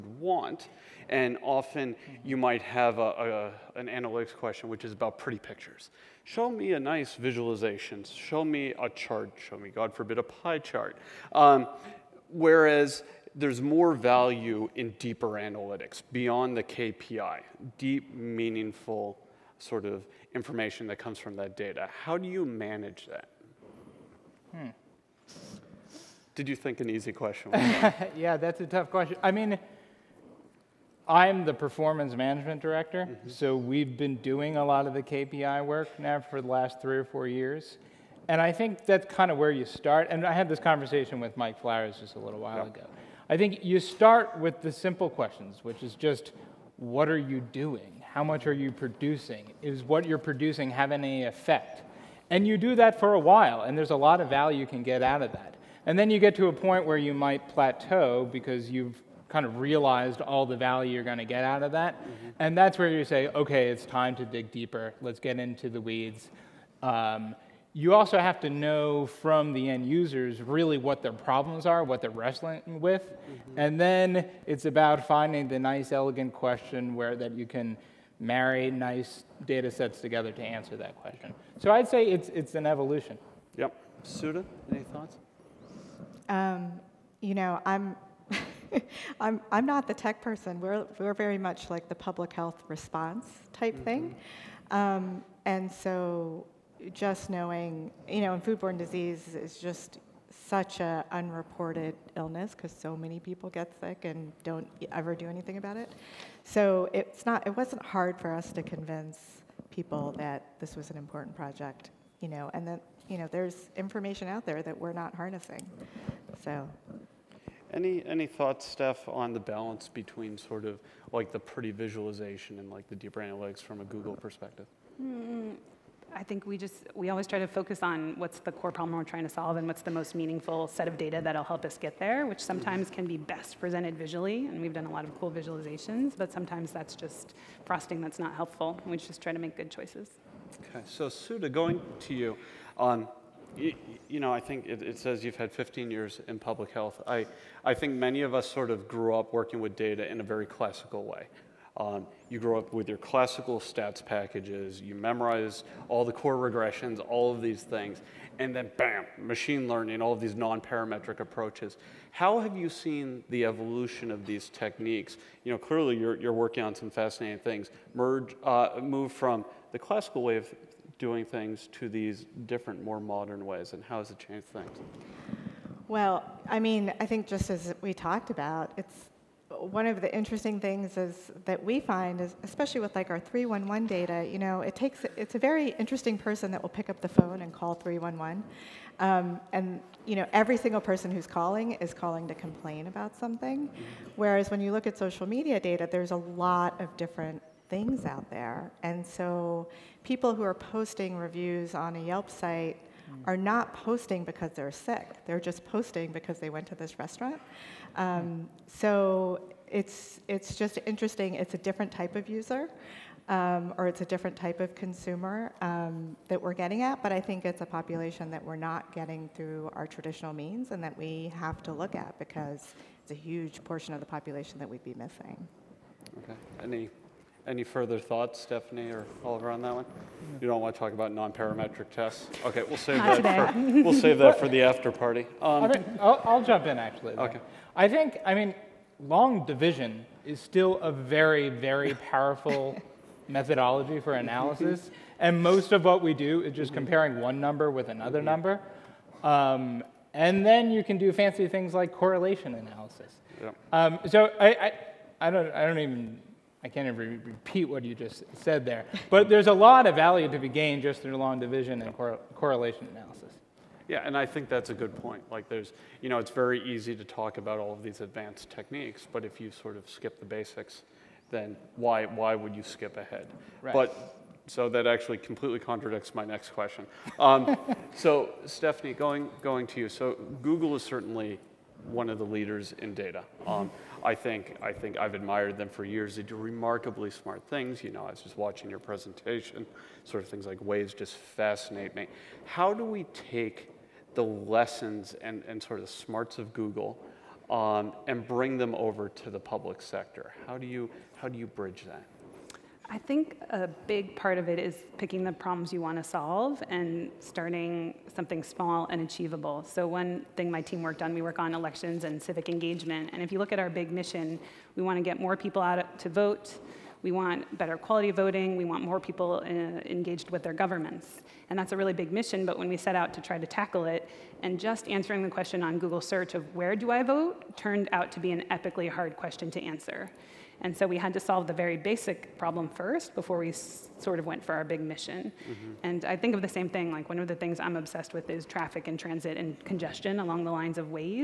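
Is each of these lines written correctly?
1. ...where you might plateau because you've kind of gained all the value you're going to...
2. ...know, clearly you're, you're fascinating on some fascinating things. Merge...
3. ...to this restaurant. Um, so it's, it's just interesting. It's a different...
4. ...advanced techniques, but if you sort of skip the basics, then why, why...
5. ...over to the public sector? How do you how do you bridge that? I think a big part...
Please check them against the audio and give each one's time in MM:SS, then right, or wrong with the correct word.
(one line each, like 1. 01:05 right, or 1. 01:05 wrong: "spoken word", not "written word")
1. 00:56 wrong: "realized", not "gained"
2. 02:45 wrong: "working", not "fascinating"
3. 03:26 right
4. 04:28 right
5. 04:58 right.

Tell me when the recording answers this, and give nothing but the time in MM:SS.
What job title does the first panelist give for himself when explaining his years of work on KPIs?
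00:31.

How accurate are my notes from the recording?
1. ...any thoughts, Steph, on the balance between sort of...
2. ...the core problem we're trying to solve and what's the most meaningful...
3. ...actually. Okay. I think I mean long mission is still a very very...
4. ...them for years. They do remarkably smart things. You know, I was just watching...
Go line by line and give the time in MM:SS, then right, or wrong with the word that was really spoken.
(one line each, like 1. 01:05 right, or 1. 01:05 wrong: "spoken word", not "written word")
1. 01:58 right
2. 02:08 right
3. 03:56 wrong: "division", not "mission"
4. 04:45 right.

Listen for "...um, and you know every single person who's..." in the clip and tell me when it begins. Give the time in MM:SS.
03:08.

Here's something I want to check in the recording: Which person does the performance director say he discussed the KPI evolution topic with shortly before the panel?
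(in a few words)
Mike Flowers.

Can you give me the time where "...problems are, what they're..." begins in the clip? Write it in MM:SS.
01:11.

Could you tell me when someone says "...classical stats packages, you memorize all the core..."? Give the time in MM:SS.
02:32.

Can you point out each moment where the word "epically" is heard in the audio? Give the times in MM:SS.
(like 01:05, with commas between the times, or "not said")
05:28.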